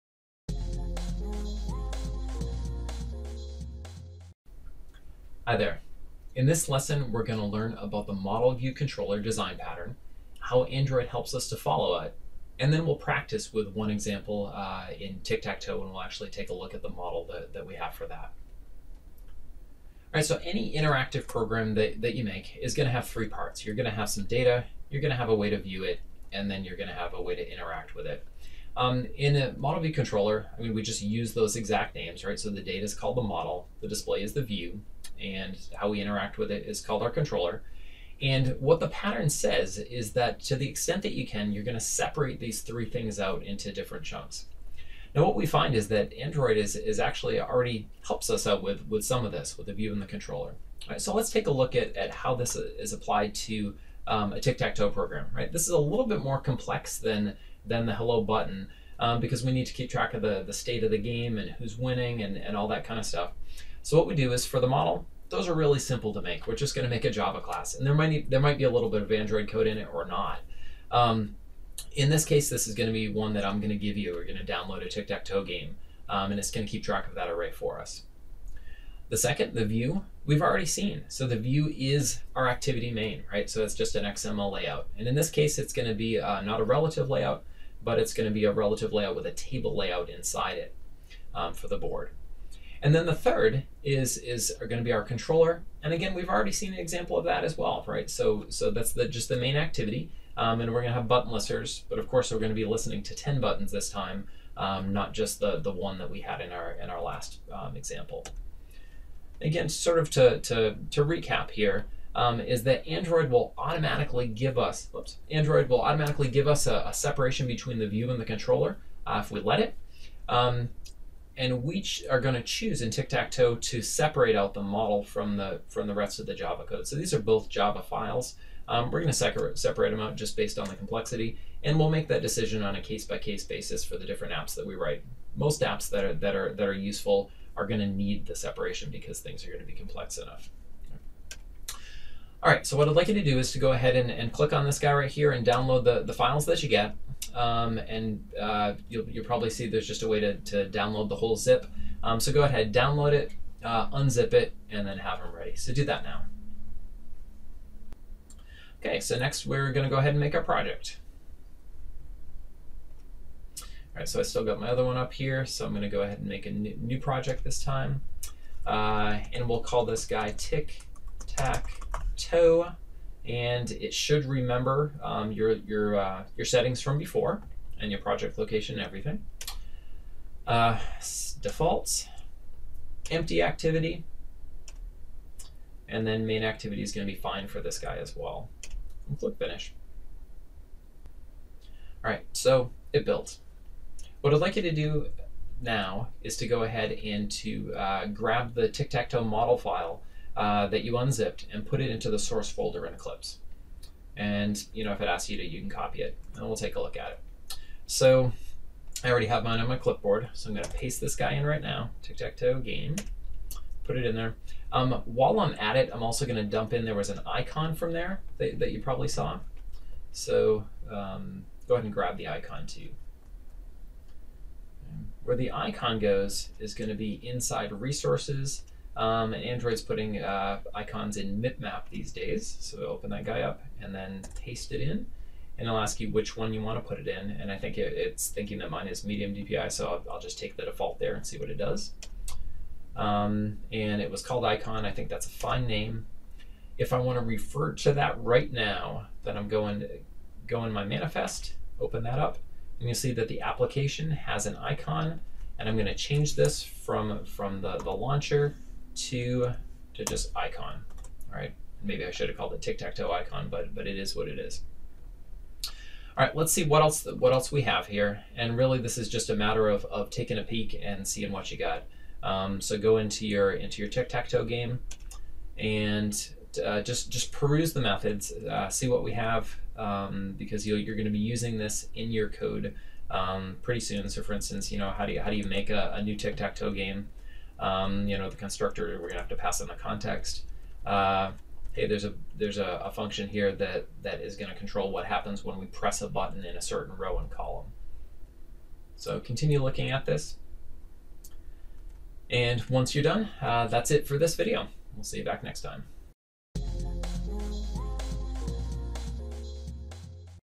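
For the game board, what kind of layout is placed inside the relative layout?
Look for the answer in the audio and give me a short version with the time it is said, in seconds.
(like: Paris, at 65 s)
Table layout, at 89 s.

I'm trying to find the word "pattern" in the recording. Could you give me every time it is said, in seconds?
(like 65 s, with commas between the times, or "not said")
9 s, 38 s.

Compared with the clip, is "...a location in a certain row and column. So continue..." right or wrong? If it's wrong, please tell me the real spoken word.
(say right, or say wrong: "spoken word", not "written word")
wrong: "button", not "location".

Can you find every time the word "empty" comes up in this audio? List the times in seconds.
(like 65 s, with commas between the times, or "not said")
183 s.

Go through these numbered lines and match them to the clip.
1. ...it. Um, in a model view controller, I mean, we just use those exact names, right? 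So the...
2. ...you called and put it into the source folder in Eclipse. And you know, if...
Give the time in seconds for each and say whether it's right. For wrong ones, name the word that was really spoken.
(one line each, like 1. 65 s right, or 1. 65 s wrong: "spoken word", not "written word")
1. 28 s right
2. 200 s wrong: "unzipped", not "called".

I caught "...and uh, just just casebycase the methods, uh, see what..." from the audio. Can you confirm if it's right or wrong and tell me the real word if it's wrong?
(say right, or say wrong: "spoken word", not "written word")
wrong: "peruse", not "casebycase".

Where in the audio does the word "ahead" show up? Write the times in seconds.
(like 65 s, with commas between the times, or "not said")
143 s, 152 s, 159 s, 166 s, 196 s, 221 s.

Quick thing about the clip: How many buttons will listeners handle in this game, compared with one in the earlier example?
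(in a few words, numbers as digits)
10.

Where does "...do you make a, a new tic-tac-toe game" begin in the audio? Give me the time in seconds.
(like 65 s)
285 s.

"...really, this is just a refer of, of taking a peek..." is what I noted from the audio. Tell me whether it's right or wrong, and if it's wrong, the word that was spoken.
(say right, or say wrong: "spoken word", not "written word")
wrong: "matter", not "refer".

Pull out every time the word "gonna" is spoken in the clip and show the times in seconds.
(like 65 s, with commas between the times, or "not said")
210 s, 216 s, 289 s, 294 s.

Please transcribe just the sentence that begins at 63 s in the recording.
So what we do is for the model, those are really simple to make.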